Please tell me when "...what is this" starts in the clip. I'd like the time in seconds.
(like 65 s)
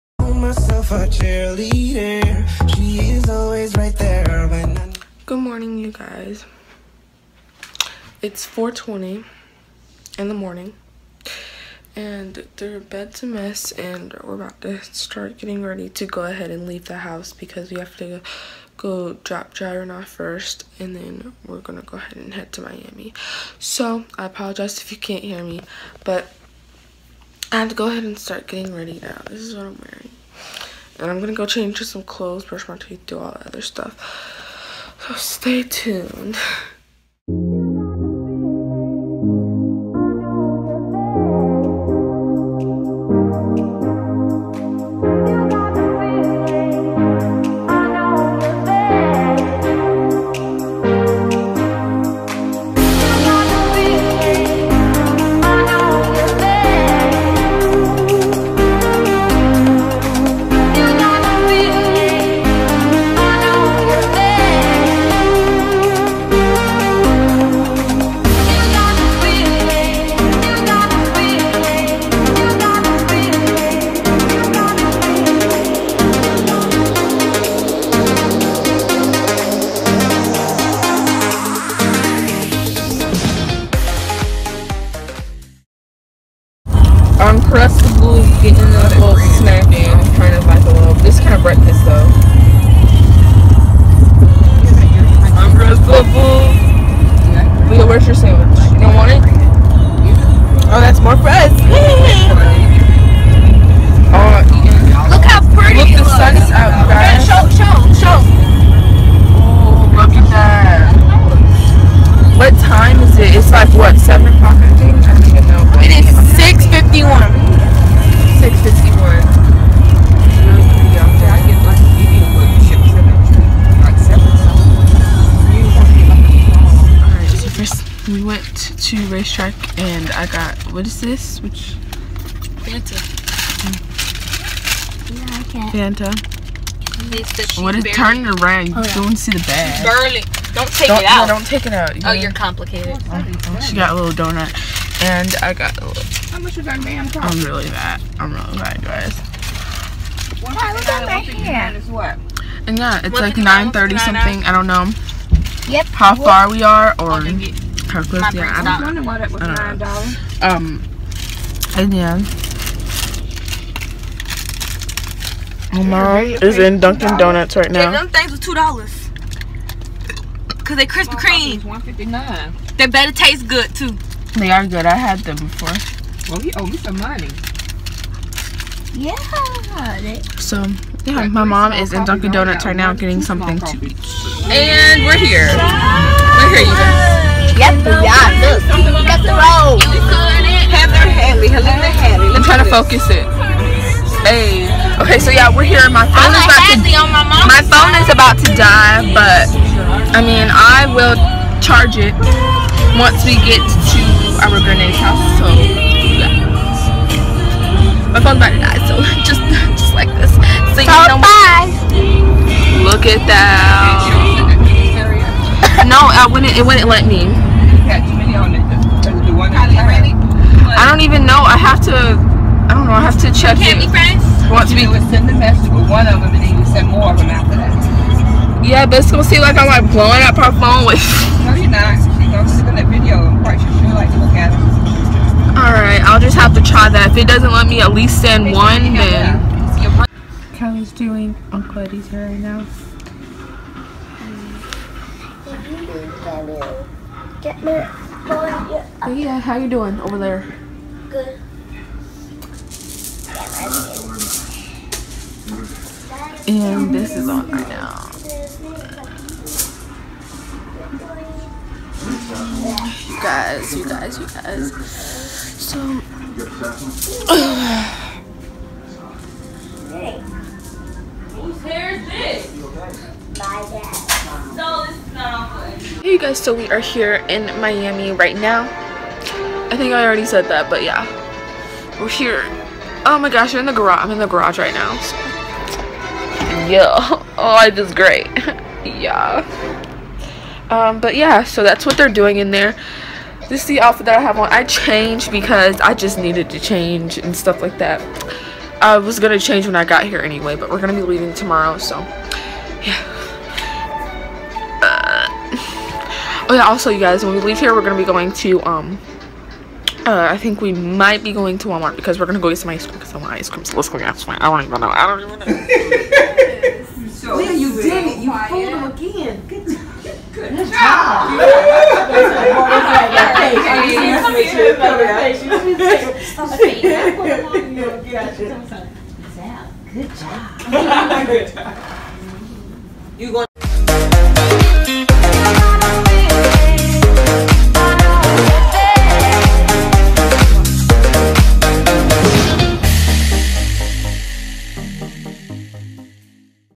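130 s.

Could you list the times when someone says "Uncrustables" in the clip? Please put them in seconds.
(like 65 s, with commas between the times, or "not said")
87 s, 95 s.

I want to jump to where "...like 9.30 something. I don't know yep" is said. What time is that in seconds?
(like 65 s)
153 s.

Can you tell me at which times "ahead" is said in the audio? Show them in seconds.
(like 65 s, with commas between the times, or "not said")
16 s, 21 s, 27 s.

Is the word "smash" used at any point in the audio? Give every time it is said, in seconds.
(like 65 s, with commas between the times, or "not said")
not said.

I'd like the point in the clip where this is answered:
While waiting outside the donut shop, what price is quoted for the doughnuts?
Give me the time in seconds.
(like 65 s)
171 s.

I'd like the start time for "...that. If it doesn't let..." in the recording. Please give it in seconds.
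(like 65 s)
236 s.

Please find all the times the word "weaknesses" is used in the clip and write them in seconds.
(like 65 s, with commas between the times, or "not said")
not said.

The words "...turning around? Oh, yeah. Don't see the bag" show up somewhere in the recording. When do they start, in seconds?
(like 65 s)
137 s.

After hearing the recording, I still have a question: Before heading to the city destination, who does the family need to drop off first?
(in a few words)
Jaron.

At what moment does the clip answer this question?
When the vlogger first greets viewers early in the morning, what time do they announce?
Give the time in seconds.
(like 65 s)
8 s.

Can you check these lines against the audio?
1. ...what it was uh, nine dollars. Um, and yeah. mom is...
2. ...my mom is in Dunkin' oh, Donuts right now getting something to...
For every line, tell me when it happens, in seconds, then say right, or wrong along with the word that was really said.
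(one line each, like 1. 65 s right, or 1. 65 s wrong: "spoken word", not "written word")
1. 159 s right
2. 181 s right.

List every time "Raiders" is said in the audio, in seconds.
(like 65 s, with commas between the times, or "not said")
not said.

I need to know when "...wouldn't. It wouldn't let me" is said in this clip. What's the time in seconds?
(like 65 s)
216 s.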